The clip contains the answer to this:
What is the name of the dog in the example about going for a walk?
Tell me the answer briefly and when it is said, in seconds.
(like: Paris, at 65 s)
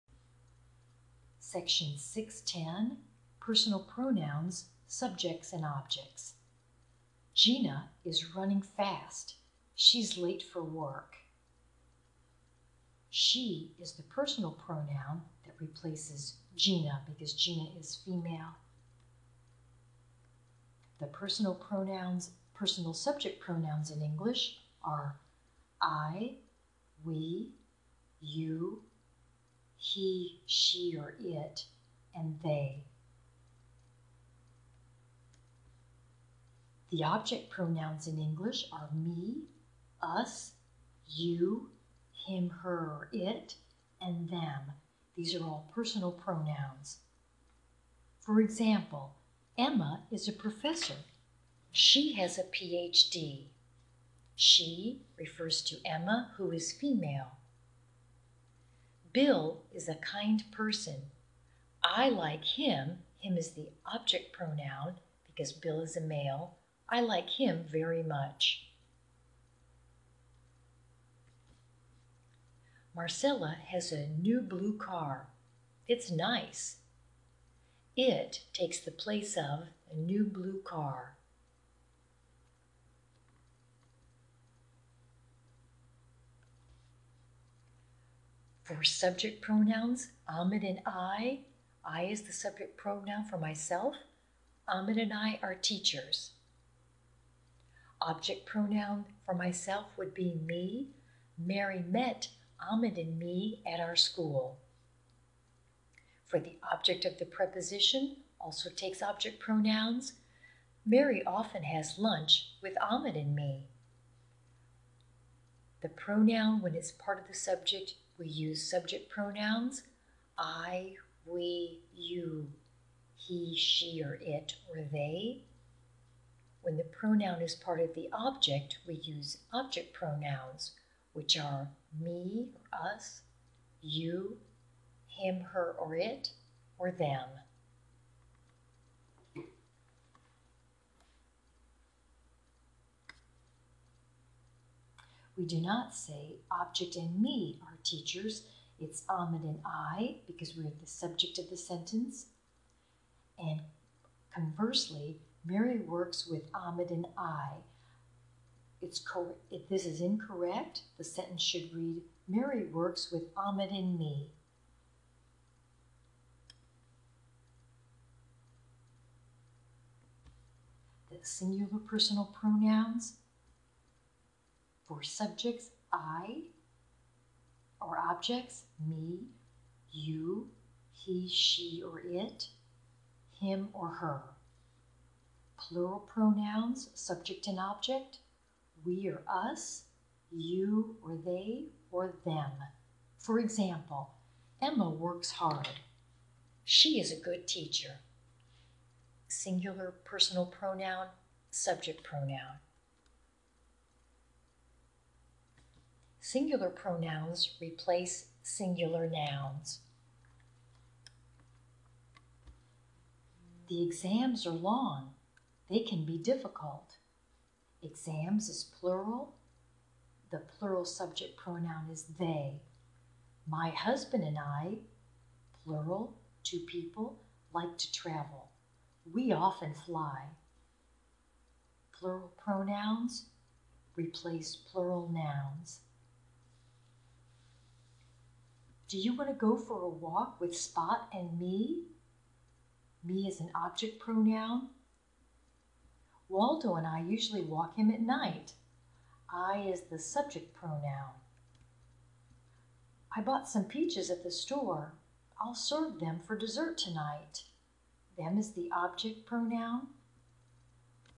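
Spot, at 240 s.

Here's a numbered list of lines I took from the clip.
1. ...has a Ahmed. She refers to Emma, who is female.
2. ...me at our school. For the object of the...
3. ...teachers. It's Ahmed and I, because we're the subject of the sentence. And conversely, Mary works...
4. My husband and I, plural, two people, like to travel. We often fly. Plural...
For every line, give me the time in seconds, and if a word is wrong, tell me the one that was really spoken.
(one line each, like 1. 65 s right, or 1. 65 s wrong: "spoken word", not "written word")
1. 52 s wrong: "PhD", not "Ahmed"
2. 103 s right
3. 147 s right
4. 223 s right.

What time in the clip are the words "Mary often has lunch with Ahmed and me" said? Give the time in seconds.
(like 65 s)
110 s.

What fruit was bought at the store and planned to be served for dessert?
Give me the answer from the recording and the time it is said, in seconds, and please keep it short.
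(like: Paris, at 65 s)
peaches, at 253 s.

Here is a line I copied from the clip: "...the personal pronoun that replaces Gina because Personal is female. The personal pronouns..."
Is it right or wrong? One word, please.
wrong.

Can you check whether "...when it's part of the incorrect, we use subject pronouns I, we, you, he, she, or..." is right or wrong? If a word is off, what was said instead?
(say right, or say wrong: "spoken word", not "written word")
wrong: "subject", not "incorrect".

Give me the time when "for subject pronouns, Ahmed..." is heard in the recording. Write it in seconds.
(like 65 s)
88 s.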